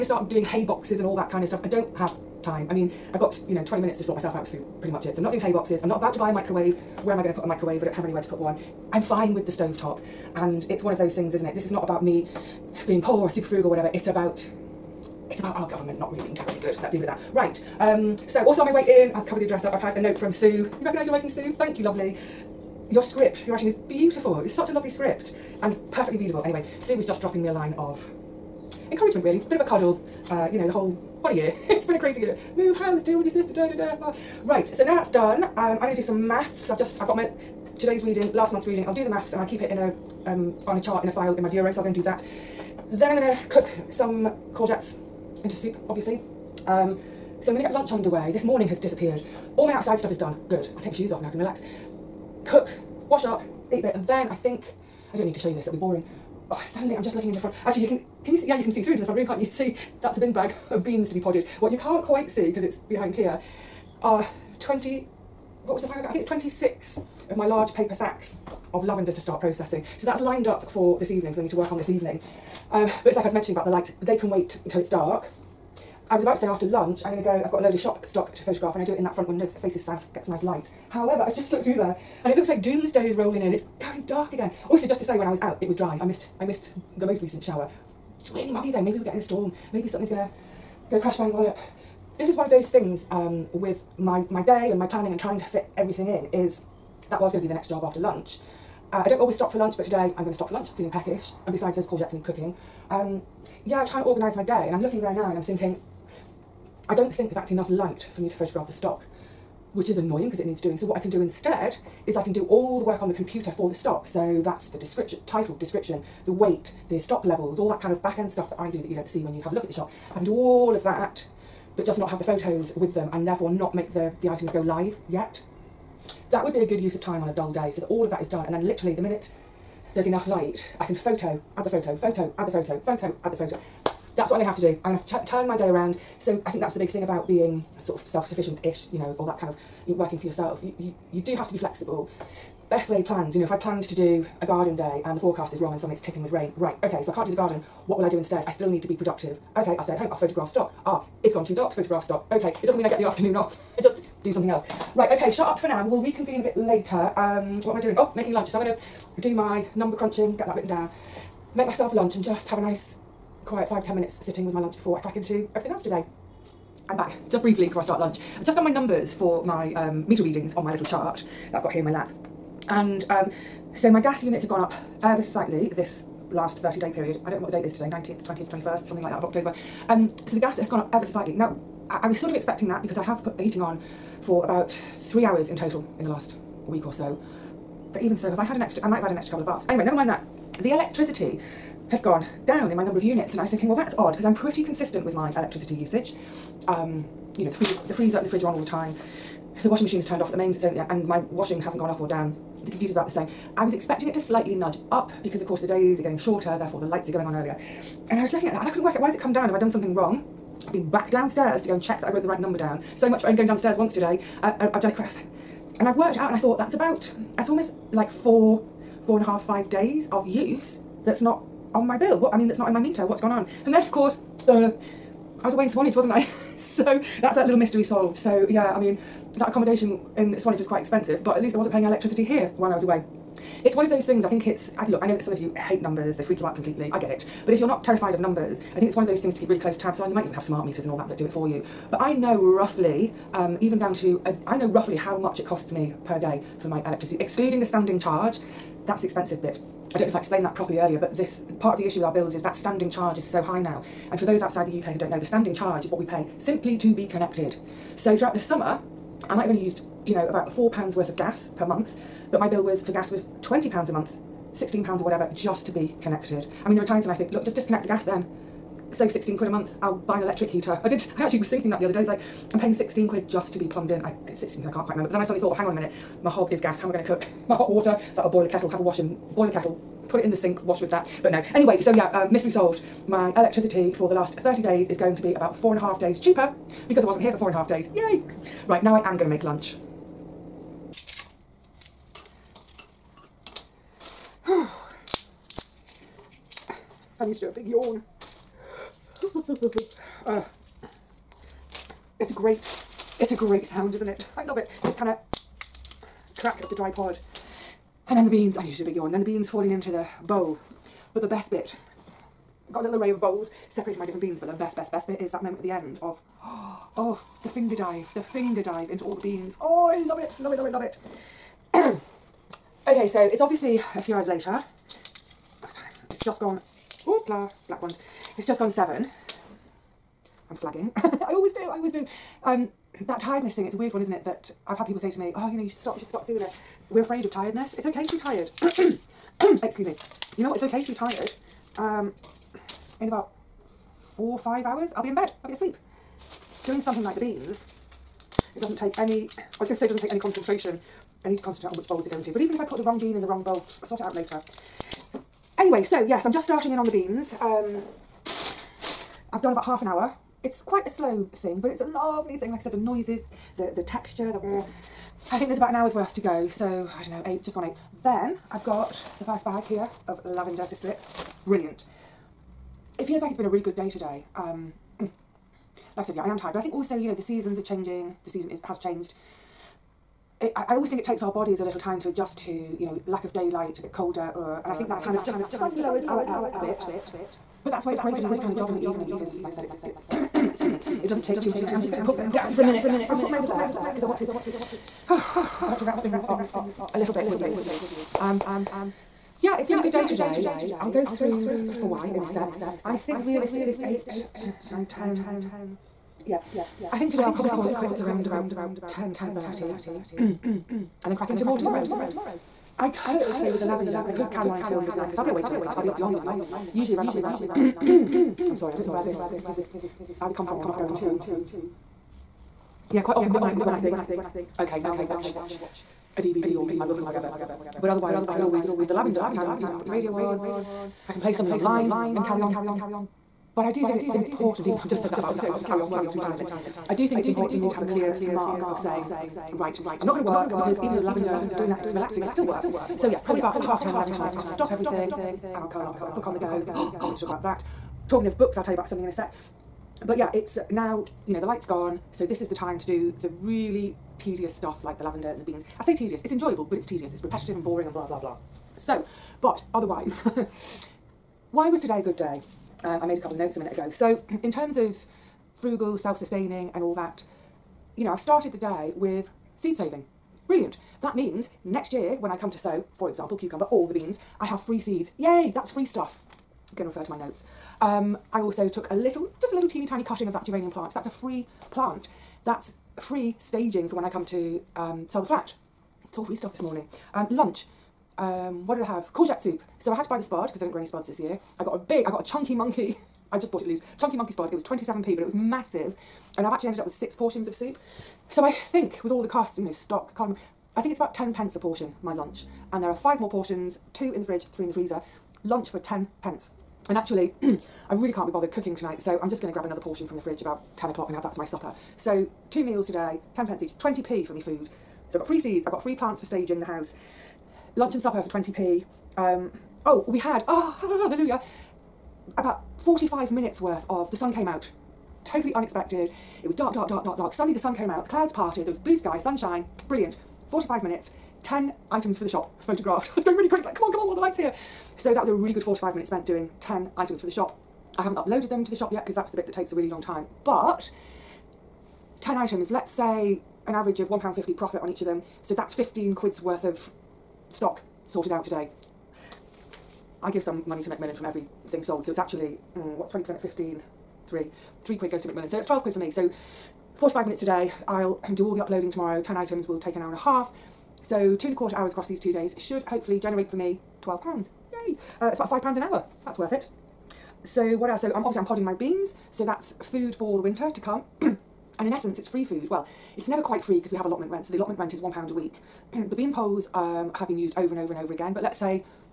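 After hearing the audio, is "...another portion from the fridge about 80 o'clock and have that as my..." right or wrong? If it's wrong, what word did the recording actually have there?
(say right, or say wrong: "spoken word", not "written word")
wrong: "10", not "80".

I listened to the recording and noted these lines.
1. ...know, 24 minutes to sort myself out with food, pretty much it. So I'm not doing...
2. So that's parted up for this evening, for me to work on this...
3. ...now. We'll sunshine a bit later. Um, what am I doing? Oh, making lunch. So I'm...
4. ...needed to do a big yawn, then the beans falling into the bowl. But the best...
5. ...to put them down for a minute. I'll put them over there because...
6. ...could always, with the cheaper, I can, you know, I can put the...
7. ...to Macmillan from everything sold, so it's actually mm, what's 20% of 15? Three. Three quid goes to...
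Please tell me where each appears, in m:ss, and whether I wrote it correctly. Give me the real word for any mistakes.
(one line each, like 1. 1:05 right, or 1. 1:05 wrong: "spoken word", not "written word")
1. 0:03 wrong: "20", not "24"
2. 1:09 wrong: "lined", not "parted"
3. 2:35 wrong: "reconvene", not "sunshine"
4. 5:08 right
5. 6:31 right
6. 7:08 wrong: "lavender", not "cheaper"
7. 9:10 right.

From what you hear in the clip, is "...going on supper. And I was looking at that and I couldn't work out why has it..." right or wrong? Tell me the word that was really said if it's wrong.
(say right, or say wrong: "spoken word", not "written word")
wrong: "earlier", not "supper".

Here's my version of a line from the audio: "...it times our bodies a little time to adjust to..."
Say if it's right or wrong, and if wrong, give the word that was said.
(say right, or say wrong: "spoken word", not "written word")
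wrong: "takes", not "times".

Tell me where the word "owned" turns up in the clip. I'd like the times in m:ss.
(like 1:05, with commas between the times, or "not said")
not said.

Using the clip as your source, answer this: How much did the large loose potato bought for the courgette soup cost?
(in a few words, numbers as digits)
27p.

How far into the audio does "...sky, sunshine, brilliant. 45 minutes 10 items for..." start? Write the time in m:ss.
8:48.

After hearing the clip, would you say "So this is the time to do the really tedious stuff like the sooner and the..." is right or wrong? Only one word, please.
wrong.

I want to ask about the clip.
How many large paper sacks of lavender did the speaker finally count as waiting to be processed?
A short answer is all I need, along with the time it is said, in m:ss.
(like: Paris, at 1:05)
26, at 1:06.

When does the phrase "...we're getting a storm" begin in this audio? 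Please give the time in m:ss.
1:28.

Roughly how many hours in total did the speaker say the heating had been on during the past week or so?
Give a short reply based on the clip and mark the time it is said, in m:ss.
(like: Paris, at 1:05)
3 hours, at 3:04.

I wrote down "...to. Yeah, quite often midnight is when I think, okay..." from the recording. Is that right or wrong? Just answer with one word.
right.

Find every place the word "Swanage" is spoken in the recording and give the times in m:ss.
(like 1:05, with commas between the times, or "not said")
3:45, 3:50.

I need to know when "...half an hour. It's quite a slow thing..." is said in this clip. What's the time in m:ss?
5:59.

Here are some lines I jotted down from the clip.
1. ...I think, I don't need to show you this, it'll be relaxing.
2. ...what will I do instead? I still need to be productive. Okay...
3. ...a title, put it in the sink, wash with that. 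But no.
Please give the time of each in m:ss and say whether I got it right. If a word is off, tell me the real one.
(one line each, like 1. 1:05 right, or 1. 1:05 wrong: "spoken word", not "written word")
1. 0:54 wrong: "boring", not "relaxing"
2. 2:27 right
3. 4:39 wrong: "kettle", not "title".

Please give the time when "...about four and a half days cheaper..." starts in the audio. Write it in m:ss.
4:45.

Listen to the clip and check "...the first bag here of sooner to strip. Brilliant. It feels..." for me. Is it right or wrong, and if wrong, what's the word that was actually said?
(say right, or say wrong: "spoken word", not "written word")
wrong: "lavender", not "sooner".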